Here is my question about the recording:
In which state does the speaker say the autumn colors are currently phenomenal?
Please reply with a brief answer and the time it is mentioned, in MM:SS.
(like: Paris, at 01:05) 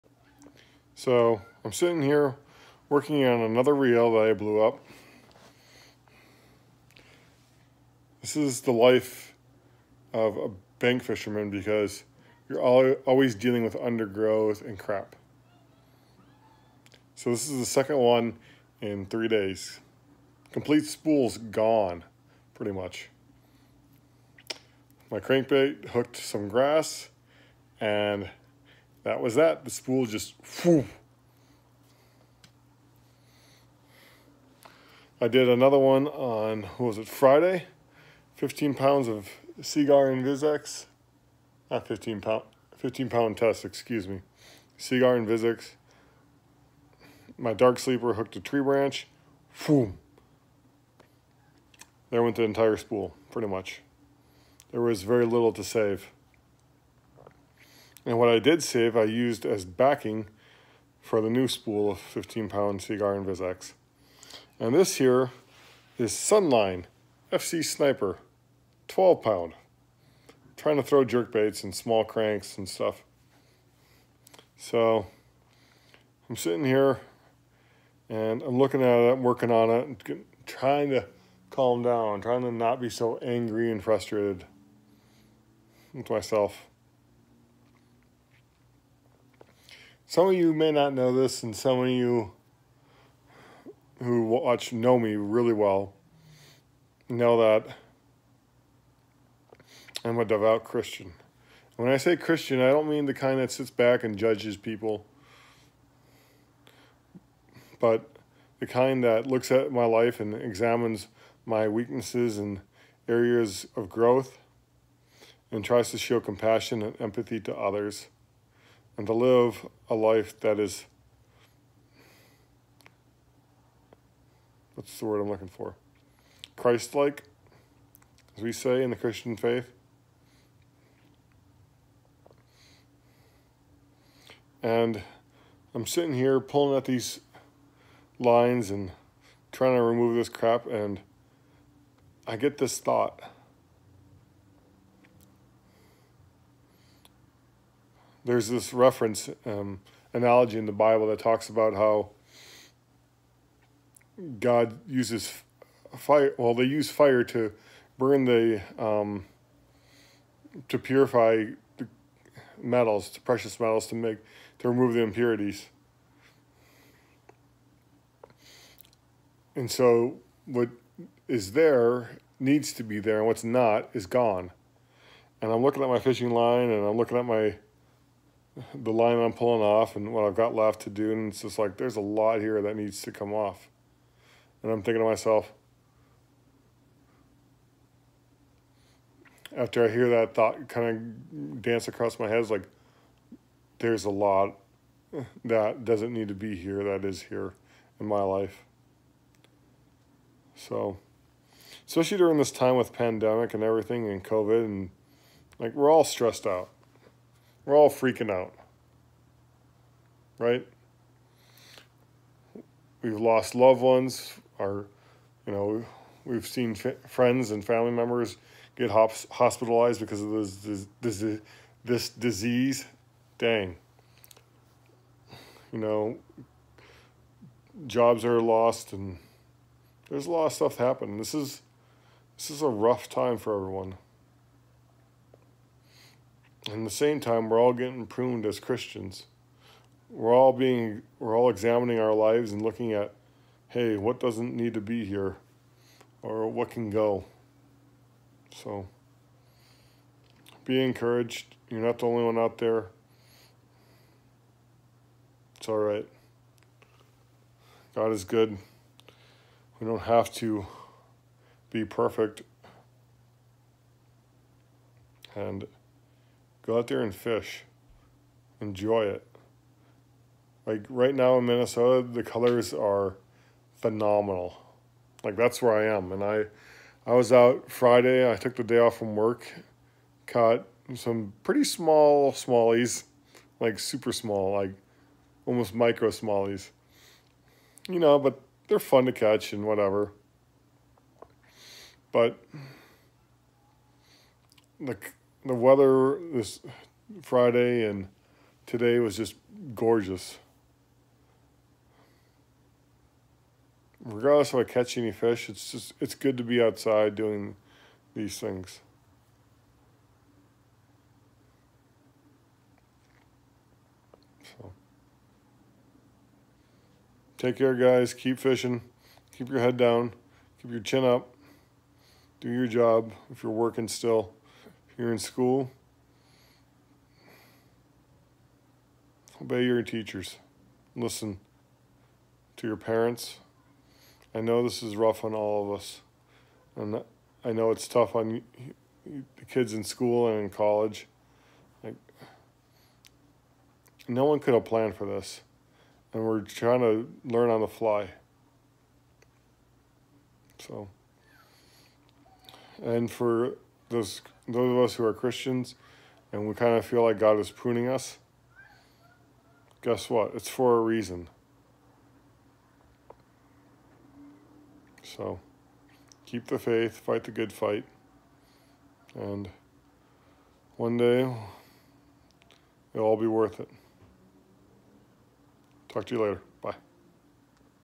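Minnesota, at 04:31.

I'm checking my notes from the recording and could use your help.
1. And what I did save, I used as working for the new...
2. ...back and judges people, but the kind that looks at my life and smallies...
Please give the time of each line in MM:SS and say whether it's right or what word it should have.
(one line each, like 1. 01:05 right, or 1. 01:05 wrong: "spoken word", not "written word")
1. 00:58 wrong: "backing", not "working"
2. 01:43 wrong: "examines", not "smallies".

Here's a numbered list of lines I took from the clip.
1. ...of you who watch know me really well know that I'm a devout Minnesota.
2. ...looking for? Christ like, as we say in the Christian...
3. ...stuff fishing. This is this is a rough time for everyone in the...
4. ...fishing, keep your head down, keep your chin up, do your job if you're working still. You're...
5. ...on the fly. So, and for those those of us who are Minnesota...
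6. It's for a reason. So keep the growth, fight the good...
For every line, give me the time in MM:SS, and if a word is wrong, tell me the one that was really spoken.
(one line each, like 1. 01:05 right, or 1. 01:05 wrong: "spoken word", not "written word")
1. 01:31 wrong: "Christian", not "Minnesota"
2. 02:05 right
3. 03:50 wrong: "happening", not "fishing"
4. 05:18 right
5. 05:47 wrong: "Christians", not "Minnesota"
6. 06:00 wrong: "faith", not "growth".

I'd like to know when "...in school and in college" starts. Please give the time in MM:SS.
05:39.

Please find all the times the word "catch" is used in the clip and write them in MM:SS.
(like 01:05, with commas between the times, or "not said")
04:49, 05:04.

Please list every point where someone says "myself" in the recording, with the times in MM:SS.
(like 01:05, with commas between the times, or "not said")
01:26, 03:05.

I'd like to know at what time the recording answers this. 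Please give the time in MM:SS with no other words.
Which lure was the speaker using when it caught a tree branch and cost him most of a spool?
00:47.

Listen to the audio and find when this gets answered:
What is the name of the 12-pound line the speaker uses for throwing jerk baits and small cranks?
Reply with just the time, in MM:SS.
01:06.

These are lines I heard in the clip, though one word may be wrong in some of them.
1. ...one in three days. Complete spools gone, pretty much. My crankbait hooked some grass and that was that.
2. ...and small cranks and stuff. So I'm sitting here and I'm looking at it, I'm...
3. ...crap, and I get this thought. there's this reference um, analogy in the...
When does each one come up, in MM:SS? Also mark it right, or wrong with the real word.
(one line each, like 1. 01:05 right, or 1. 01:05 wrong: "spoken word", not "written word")
1. 00:17 right
2. 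01:11 right
3. 02:20 right.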